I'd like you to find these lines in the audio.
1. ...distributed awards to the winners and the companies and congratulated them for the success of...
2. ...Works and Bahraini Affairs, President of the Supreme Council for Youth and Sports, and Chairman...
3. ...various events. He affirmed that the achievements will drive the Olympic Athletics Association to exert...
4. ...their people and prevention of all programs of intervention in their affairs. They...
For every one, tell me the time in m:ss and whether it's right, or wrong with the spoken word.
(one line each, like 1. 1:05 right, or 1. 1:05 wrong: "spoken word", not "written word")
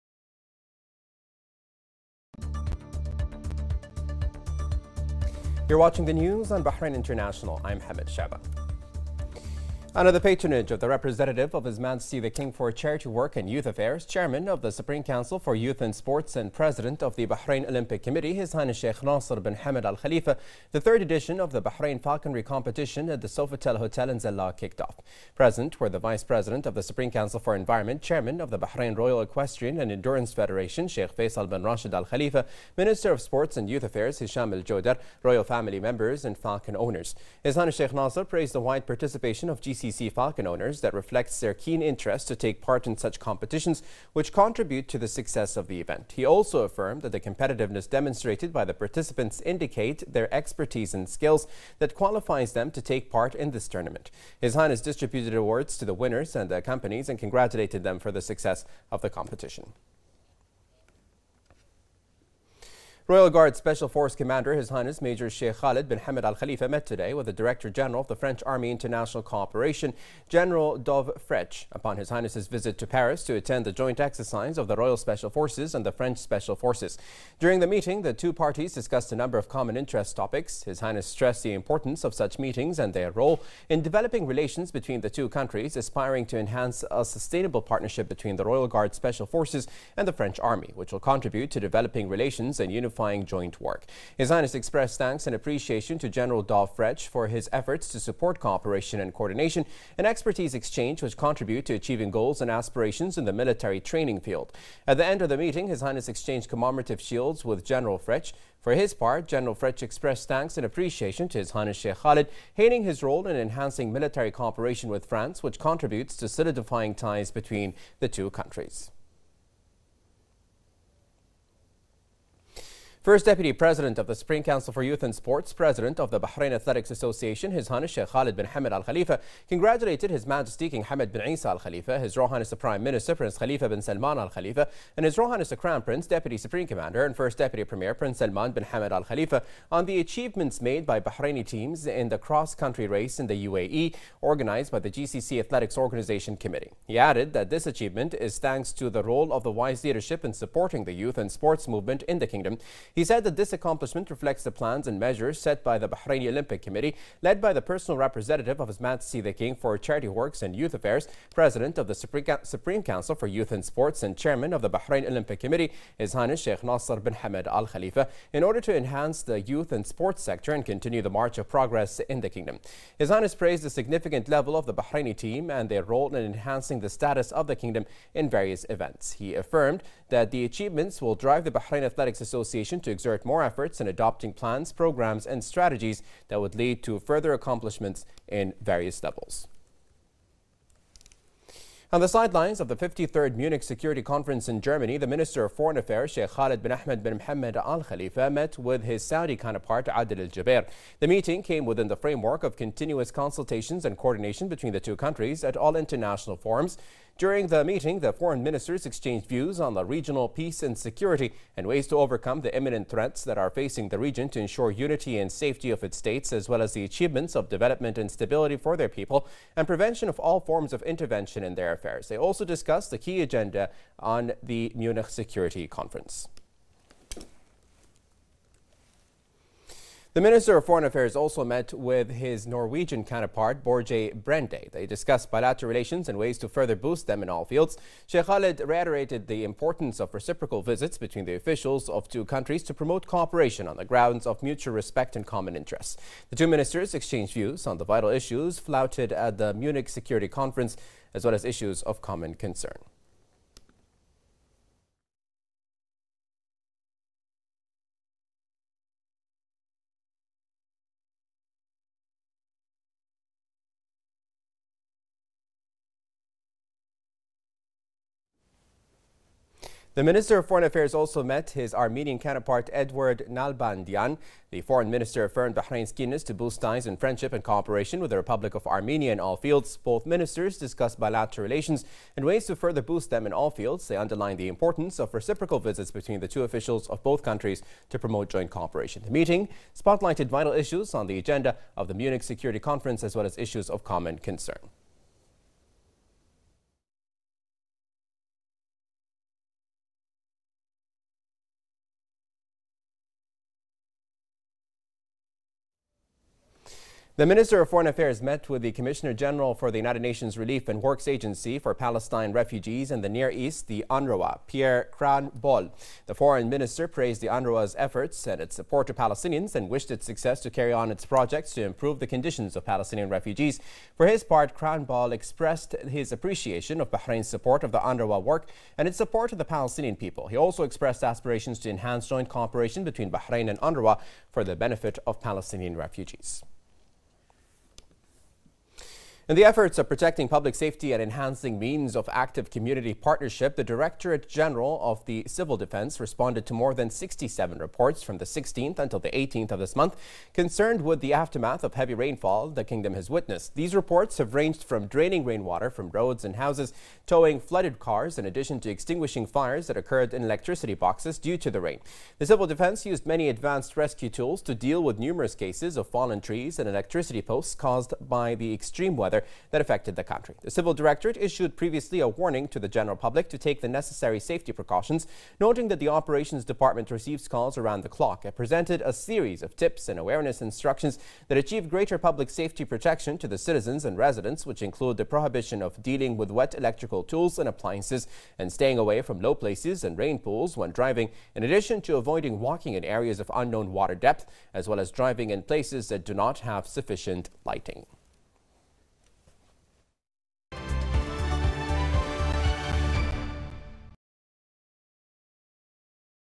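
1. 0:54 right
2. 2:40 wrong: "Youth", not "Bahraini"
3. 2:58 wrong: "Bahrain", not "Olympic"
4. 3:38 wrong: "forms", not "programs".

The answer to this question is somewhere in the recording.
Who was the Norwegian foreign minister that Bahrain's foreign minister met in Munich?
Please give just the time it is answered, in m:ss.
3:53.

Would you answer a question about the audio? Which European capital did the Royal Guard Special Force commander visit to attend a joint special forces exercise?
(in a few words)
Paris.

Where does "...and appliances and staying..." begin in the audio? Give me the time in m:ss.
6:27.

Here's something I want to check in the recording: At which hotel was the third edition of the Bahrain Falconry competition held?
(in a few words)
Sofitel Hotel.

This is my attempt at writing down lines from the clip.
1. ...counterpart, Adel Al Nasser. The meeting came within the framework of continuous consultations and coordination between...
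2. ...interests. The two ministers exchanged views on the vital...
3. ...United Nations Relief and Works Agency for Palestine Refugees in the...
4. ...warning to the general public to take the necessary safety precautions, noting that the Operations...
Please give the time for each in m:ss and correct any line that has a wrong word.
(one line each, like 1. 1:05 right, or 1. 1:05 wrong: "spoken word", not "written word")
1. 3:19 wrong: "Jubeir", not "Nasser"
2. 4:05 right
3. 5:09 right
4. 6:12 right.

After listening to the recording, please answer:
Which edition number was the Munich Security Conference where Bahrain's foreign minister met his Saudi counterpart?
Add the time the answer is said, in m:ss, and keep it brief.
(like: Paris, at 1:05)
53rd, at 3:12.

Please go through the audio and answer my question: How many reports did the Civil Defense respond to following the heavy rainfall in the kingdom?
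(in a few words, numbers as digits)
more than 67.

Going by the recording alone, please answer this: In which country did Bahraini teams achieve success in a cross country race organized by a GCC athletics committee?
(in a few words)
UAE.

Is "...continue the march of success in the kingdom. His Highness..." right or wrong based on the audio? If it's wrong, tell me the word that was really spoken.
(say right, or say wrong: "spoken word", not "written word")
wrong: "progress", not "success".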